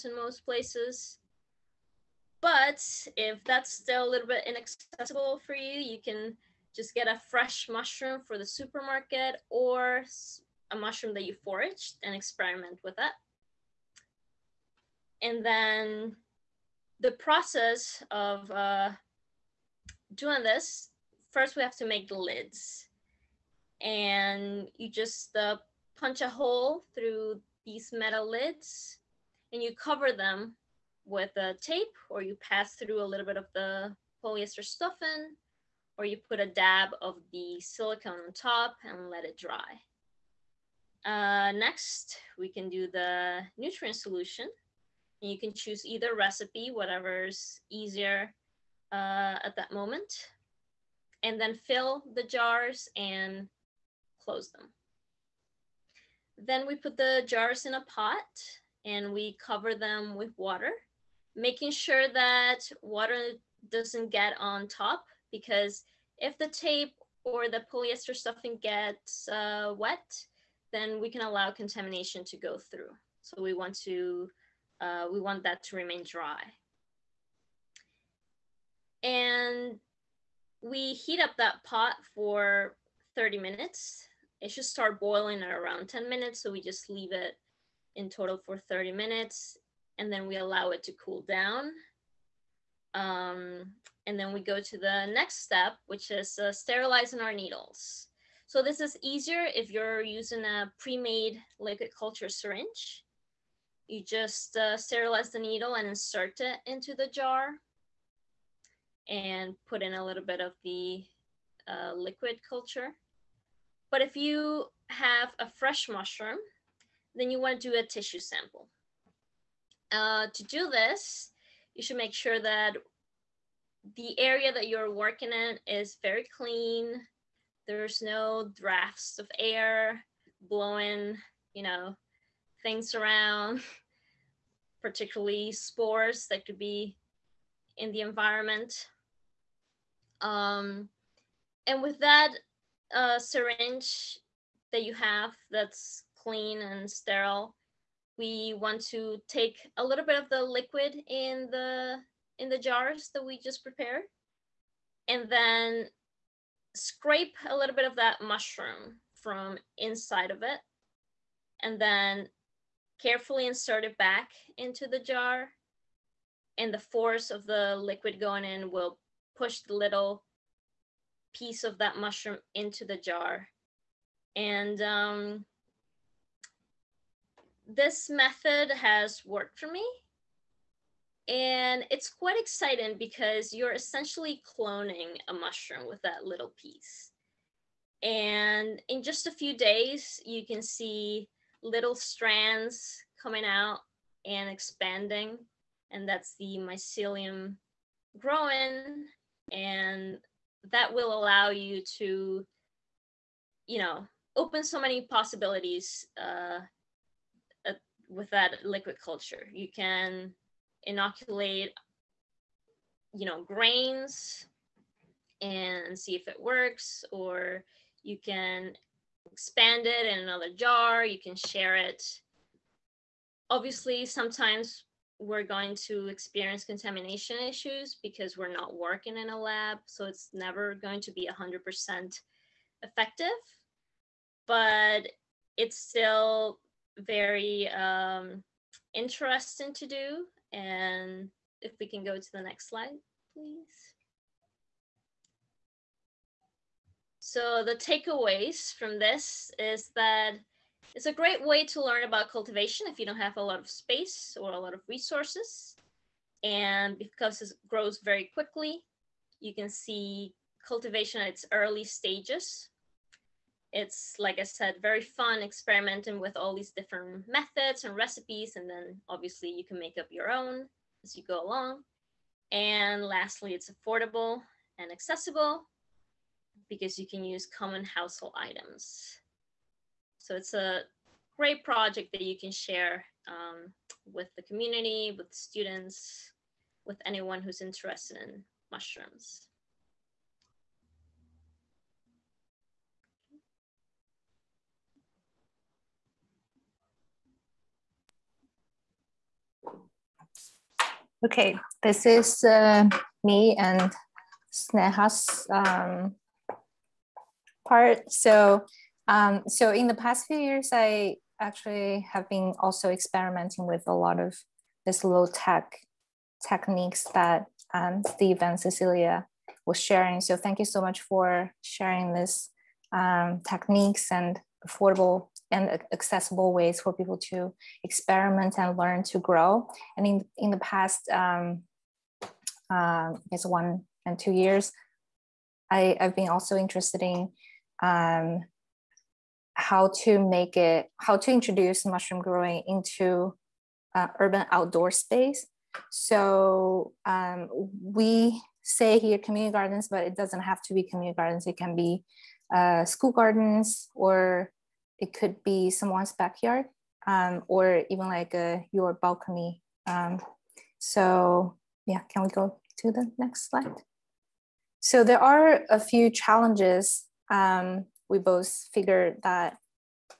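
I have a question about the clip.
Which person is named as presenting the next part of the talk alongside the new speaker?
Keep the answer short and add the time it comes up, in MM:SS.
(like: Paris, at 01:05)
Sneha, at 05:04.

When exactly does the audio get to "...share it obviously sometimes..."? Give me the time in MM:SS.
03:41.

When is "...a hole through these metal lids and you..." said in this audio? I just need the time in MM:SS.
00:26.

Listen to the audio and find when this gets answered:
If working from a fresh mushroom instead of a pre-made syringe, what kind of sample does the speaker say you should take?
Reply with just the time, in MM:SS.
01:57.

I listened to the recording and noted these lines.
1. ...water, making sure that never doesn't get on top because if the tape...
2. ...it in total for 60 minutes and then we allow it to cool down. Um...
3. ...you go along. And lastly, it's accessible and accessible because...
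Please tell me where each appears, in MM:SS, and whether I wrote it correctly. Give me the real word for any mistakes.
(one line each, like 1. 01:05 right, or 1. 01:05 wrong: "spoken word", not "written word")
1. 01:00 wrong: "water", not "never"
2. 01:27 wrong: "30", not "60"
3. 04:31 wrong: "affordable", not "accessible".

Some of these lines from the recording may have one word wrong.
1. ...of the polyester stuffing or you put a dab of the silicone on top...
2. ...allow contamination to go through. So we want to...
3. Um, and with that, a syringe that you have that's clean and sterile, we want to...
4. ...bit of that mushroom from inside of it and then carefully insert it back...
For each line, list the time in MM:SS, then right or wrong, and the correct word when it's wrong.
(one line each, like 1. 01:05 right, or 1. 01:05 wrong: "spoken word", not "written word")
1. 00:33 right
2. 01:11 right
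3. 02:20 right
4. 02:37 right.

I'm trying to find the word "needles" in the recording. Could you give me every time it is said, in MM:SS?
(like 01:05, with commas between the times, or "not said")
01:37, 01:45.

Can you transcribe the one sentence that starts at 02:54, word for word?
And um, this method has worked for me.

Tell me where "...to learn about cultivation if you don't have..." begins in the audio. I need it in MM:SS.
04:11.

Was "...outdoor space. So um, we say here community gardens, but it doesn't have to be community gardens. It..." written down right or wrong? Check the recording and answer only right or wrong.
right.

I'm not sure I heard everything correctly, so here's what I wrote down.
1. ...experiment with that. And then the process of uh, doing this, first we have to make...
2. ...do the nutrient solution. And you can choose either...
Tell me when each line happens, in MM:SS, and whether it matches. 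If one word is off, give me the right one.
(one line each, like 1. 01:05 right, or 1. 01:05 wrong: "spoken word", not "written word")
1. 00:12 right
2. 00:42 right.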